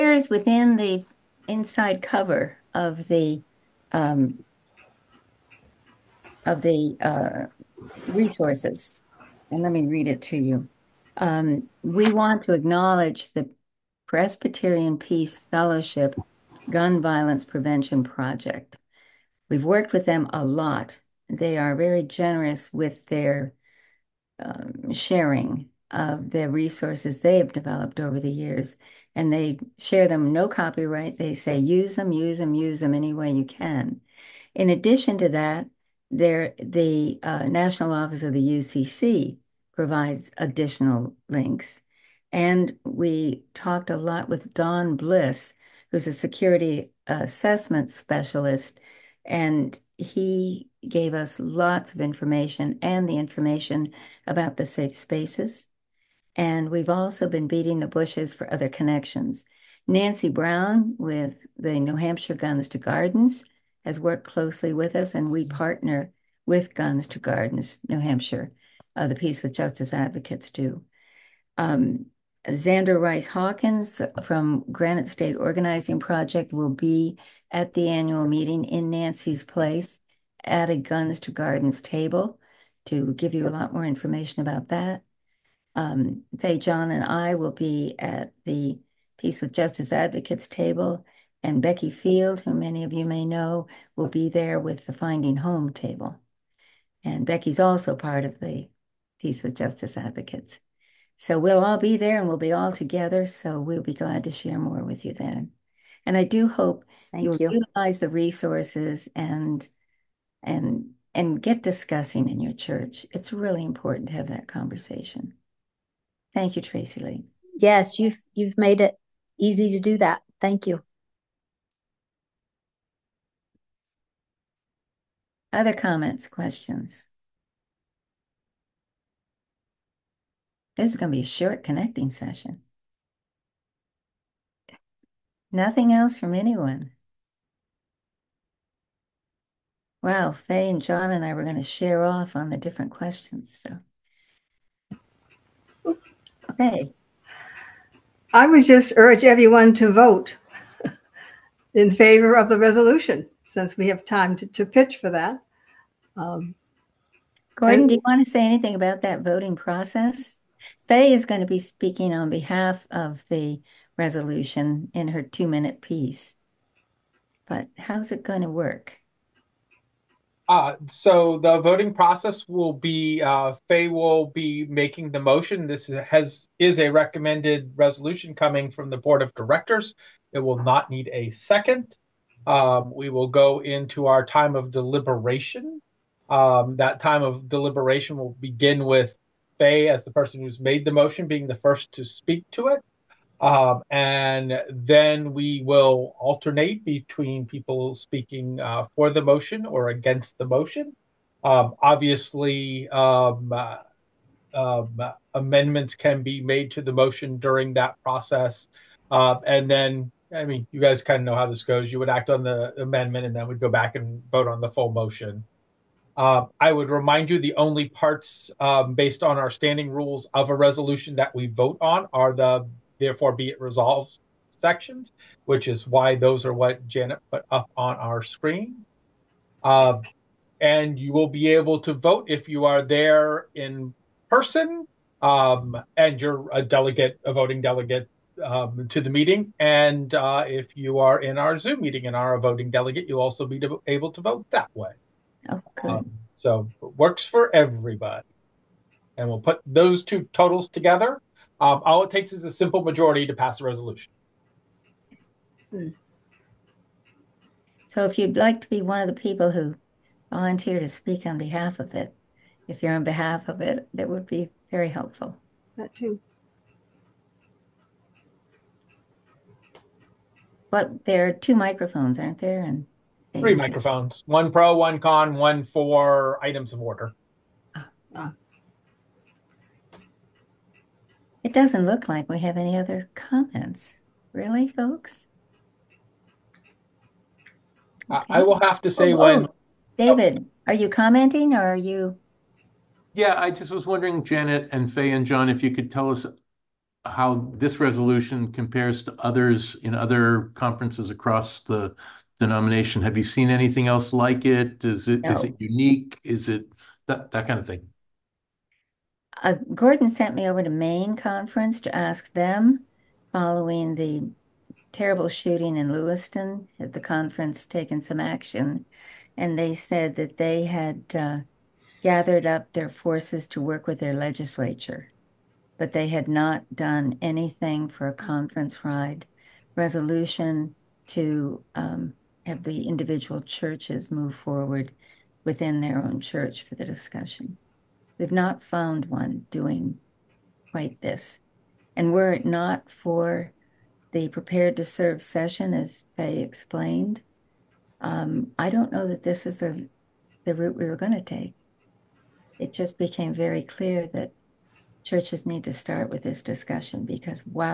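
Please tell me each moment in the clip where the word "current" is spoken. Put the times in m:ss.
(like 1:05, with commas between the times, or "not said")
not said.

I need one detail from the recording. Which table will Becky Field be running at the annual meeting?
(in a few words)
Finding Home.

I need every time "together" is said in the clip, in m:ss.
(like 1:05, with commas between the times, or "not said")
1:42, 4:10.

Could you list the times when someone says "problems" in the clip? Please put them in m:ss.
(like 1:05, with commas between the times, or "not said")
not said.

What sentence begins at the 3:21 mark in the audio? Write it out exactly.
Um, obviously, um, uh, um, amendments can be made to the motion during that process.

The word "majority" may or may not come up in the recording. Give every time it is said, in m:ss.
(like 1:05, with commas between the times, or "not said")
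4:12.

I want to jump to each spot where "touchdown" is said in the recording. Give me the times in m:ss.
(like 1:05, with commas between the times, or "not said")
not said.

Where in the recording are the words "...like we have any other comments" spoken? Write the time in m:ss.
4:42.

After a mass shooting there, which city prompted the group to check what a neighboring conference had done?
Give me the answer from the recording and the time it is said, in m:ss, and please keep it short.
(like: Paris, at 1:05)
Lewiston, at 5:15.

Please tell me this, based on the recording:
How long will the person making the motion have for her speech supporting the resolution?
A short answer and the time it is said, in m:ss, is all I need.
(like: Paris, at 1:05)
2 minutes, at 2:45.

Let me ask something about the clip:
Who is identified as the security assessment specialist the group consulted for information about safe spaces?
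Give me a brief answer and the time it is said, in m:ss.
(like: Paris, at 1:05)
Don Bliss, at 0:44.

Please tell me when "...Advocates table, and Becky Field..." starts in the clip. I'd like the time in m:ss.
1:29.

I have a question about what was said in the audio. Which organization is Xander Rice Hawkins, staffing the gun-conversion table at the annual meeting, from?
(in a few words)
Granite State Organizing Project.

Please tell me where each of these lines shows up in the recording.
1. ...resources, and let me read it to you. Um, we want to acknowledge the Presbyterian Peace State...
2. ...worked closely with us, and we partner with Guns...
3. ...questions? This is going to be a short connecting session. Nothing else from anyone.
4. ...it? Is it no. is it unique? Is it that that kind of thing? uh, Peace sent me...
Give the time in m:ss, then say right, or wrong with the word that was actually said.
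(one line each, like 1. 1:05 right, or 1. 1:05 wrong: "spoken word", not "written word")
1. 0:08 wrong: "Fellowship", not "State"
2. 1:03 right
3. 2:06 right
4. 5:04 wrong: "Gordon", not "Peace".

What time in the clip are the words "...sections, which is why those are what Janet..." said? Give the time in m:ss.
3:44.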